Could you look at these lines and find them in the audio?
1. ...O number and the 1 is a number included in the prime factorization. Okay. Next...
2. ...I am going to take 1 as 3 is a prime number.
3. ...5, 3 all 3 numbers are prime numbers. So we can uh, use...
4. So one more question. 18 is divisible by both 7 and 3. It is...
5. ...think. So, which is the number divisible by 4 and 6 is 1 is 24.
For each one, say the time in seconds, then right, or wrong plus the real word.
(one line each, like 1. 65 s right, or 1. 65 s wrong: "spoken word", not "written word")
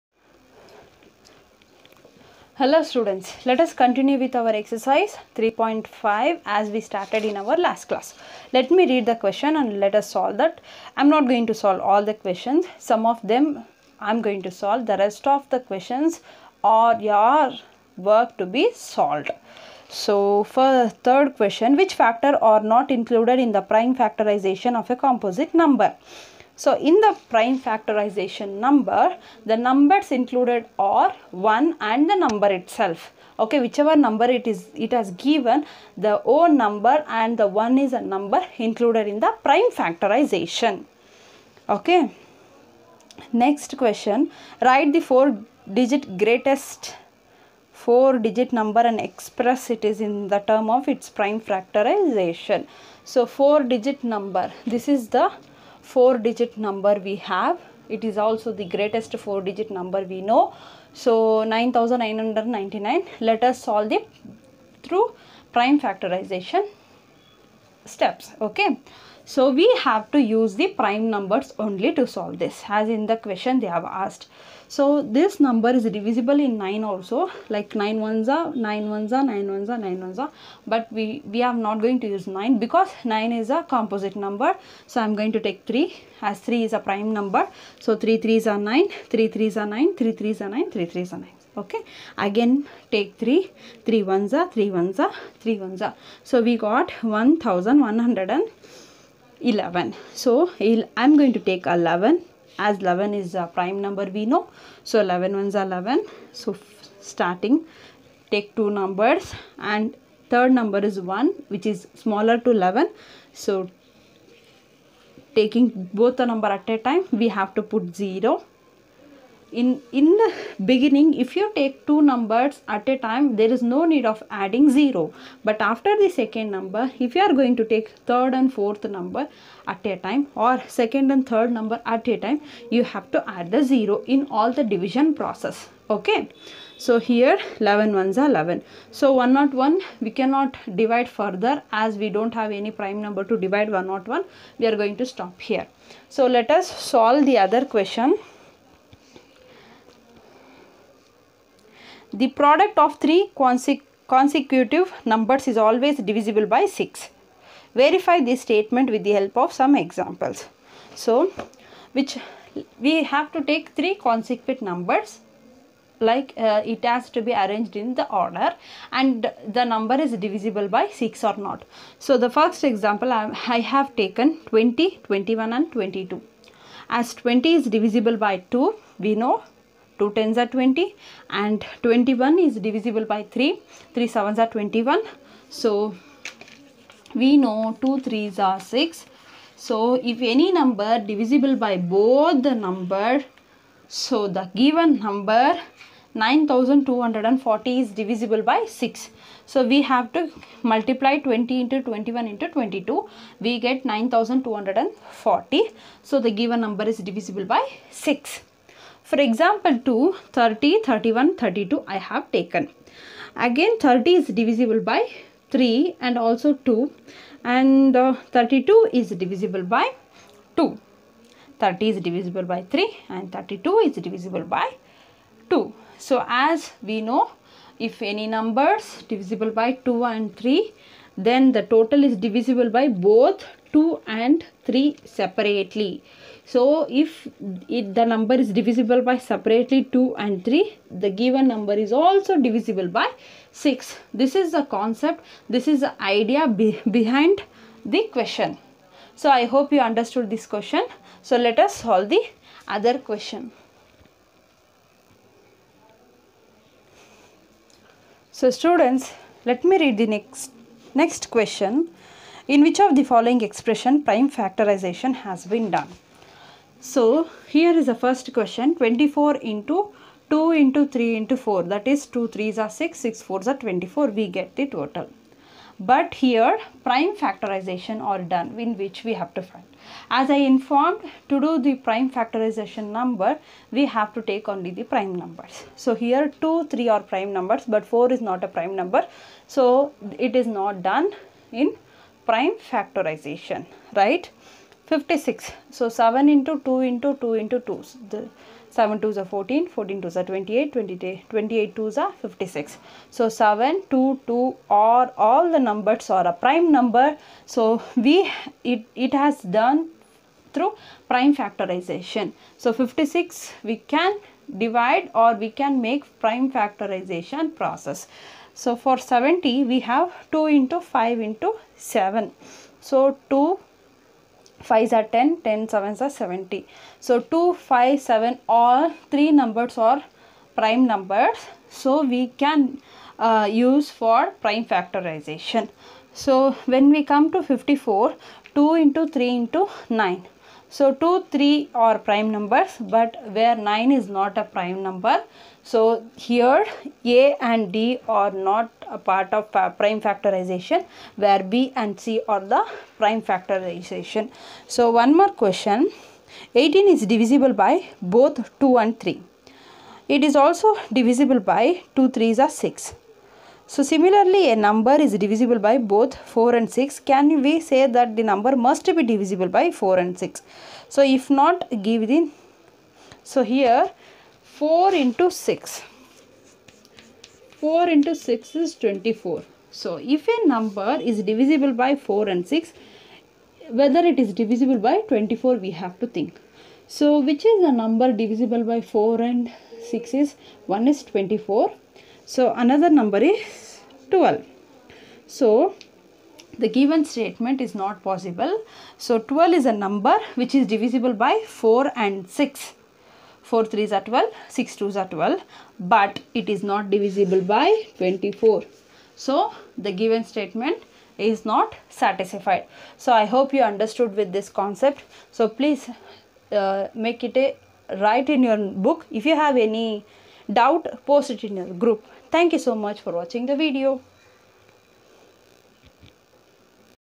1. 36 s right
2. 85 s wrong: "3", not "1"
3. 327 s wrong: "7", not "3"
4. 354 s wrong: "2", not "7"
5. 386 s right.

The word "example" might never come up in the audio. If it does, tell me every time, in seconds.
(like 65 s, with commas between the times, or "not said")
159 s, 172 s, 209 s.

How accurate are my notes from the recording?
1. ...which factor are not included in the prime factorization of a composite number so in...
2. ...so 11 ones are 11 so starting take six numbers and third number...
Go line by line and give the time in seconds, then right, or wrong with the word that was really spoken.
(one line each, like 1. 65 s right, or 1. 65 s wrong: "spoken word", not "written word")
1. 21 s right
2. 104 s wrong: "two", not "six".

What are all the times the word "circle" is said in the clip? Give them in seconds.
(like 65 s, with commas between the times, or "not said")
not said.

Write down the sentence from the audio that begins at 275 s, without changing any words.
But here prime factorization are done in which we have to find.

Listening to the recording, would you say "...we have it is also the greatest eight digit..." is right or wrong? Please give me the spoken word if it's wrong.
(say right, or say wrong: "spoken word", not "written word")
wrong: "four", not "eight".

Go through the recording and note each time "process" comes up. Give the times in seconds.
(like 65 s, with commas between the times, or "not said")
135 s, 317 s.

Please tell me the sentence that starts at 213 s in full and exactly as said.
Again, 30 is divisible by 3 and also 2 and uh, 32 is divisible by 2.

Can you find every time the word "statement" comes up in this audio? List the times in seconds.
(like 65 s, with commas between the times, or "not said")
158 s, 397 s, 410 s.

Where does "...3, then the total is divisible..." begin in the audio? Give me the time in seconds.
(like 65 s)
230 s.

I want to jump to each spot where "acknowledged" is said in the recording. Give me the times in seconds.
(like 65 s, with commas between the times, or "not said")
not said.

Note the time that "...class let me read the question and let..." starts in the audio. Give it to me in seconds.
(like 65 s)
7 s.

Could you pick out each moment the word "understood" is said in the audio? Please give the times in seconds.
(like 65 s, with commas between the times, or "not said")
249 s, 413 s.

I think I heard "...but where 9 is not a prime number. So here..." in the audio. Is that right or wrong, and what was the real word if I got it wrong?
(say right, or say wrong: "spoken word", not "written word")
right.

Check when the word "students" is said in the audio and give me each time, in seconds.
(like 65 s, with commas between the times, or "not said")
2 s, 258 s.